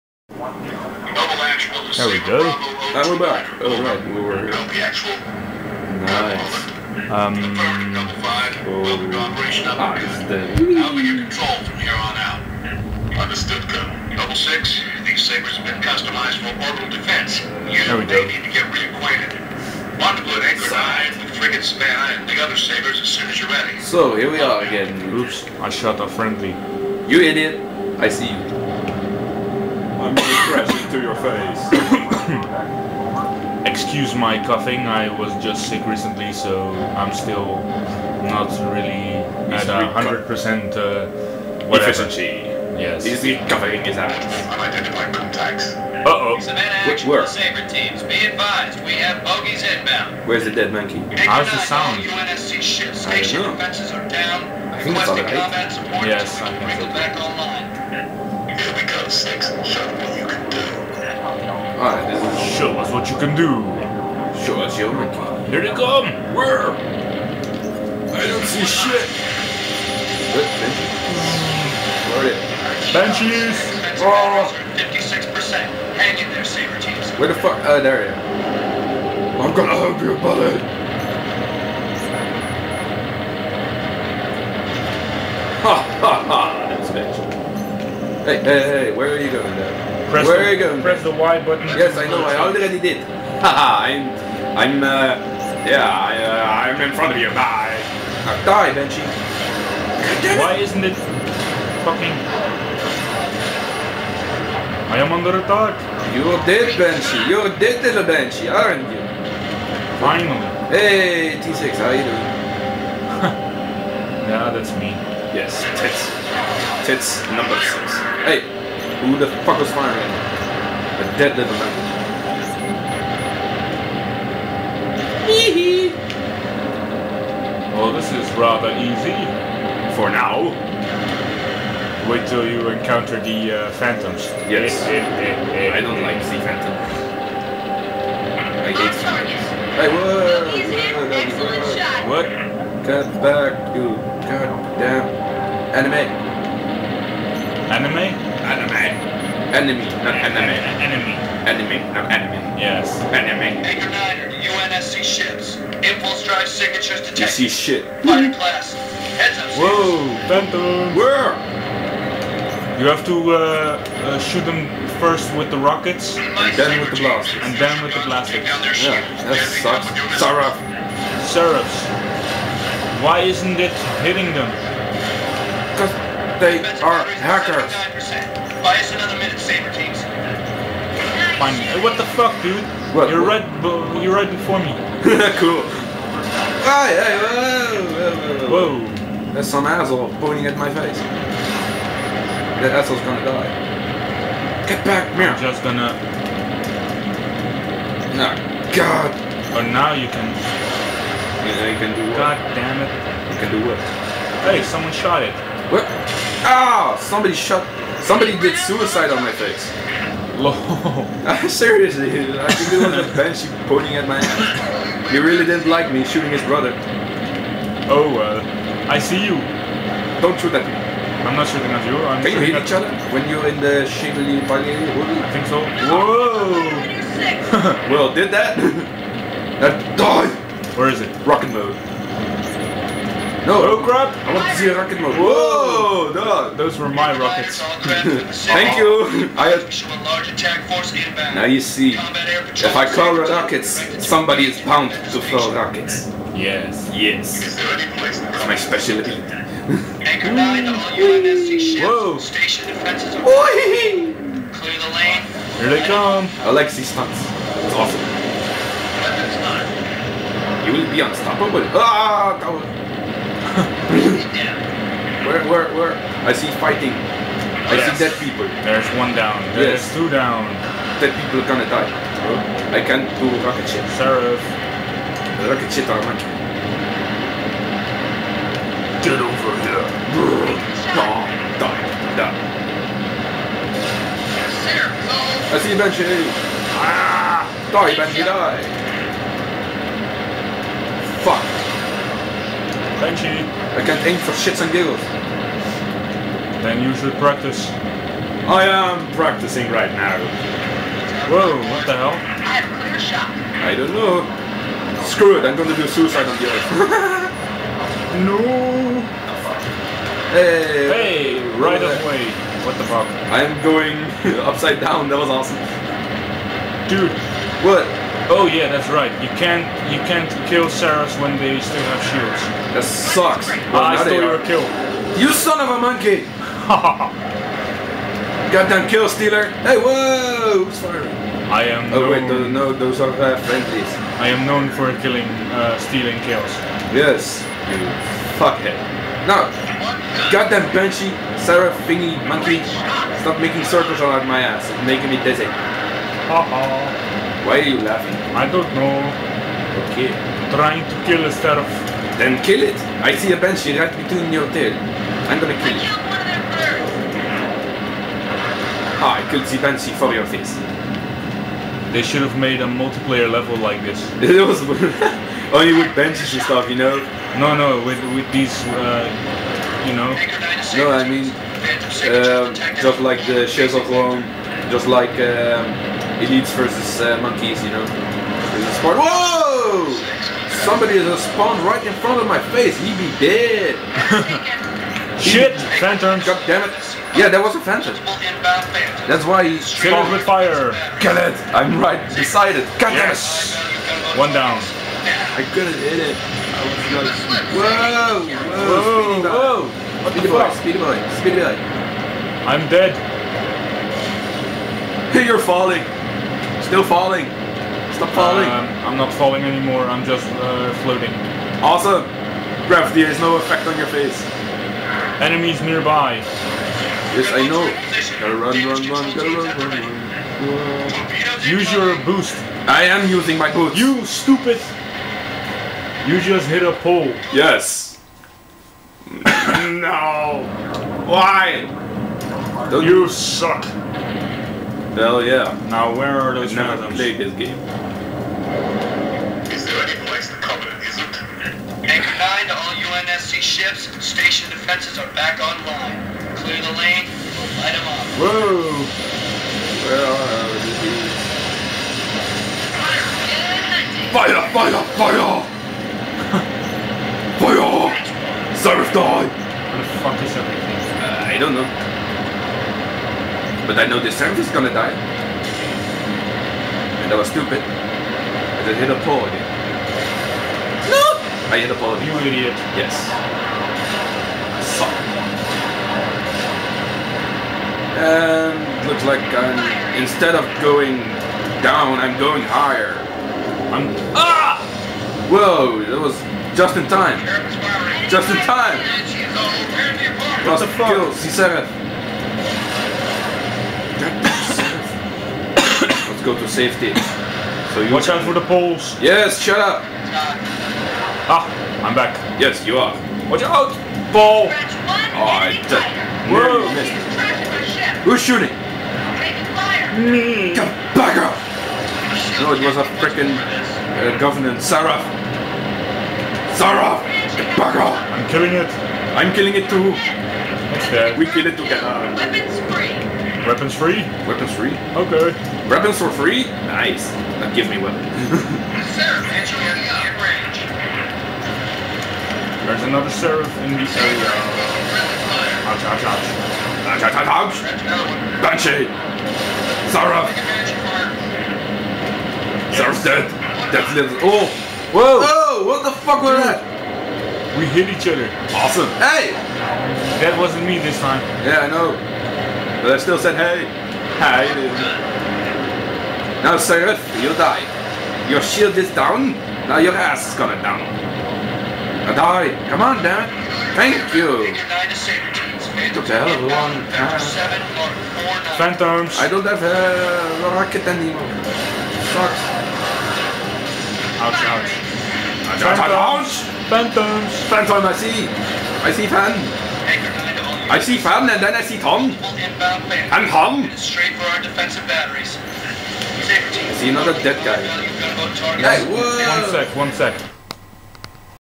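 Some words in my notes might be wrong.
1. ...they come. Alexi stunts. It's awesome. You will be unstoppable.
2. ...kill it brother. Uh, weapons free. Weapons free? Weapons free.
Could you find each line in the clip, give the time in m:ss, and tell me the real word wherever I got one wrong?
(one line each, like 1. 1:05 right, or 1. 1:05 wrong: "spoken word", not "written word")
1. 4:15 right
2. 8:41 wrong: "together", not "brother".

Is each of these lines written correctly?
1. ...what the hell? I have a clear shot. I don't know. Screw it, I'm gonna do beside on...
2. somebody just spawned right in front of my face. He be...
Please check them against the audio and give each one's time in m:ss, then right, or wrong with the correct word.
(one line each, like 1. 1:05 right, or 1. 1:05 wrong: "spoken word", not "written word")
1. 5:01 wrong: "suicide", not "beside"
2. 6:20 right.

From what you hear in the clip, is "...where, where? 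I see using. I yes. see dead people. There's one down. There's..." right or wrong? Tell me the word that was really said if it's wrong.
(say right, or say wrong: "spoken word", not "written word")
wrong: "fighting", not "using".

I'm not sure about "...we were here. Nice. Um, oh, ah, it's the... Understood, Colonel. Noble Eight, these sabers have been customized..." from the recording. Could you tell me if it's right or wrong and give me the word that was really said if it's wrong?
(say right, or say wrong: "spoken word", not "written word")
wrong: "Six", not "Eight".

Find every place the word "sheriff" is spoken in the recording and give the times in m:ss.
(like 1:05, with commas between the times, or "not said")
4:33, 8:53.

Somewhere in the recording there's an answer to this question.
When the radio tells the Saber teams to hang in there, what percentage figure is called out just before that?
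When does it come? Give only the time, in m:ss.
1:14.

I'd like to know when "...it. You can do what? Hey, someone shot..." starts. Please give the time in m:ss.
3:22.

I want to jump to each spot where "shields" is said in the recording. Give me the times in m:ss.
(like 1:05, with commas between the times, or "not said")
5:22, 9:18.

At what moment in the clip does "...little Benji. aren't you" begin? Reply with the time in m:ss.
1:47.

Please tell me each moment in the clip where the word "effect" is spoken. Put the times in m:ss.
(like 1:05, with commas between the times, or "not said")
6:53.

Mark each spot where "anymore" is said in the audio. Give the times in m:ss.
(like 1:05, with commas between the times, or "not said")
6:49, 9:30.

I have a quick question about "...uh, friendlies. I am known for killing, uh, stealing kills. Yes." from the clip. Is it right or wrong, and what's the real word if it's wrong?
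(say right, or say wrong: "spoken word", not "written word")
right.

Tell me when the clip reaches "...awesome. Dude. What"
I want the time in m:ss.
5:15.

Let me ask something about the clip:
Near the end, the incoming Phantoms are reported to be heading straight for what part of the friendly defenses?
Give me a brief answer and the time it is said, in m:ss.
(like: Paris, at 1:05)
defensive batteries, at 9:44.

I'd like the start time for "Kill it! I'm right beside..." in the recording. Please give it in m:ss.
6:30.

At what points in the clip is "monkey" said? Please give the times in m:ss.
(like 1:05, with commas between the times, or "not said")
0:50, 1:04, 5:25, 5:42, 6:17.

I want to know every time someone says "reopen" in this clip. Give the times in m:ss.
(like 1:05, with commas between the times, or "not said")
not said.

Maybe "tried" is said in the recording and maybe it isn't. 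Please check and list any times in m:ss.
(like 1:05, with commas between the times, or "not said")
not said.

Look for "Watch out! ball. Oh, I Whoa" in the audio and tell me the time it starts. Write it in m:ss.
8:23.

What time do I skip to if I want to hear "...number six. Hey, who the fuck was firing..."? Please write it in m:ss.
1:57.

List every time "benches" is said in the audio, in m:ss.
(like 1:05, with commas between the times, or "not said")
1:12, 6:05.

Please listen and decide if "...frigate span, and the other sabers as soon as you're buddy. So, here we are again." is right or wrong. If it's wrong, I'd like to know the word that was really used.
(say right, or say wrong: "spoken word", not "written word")
wrong: "ready", not "buddy".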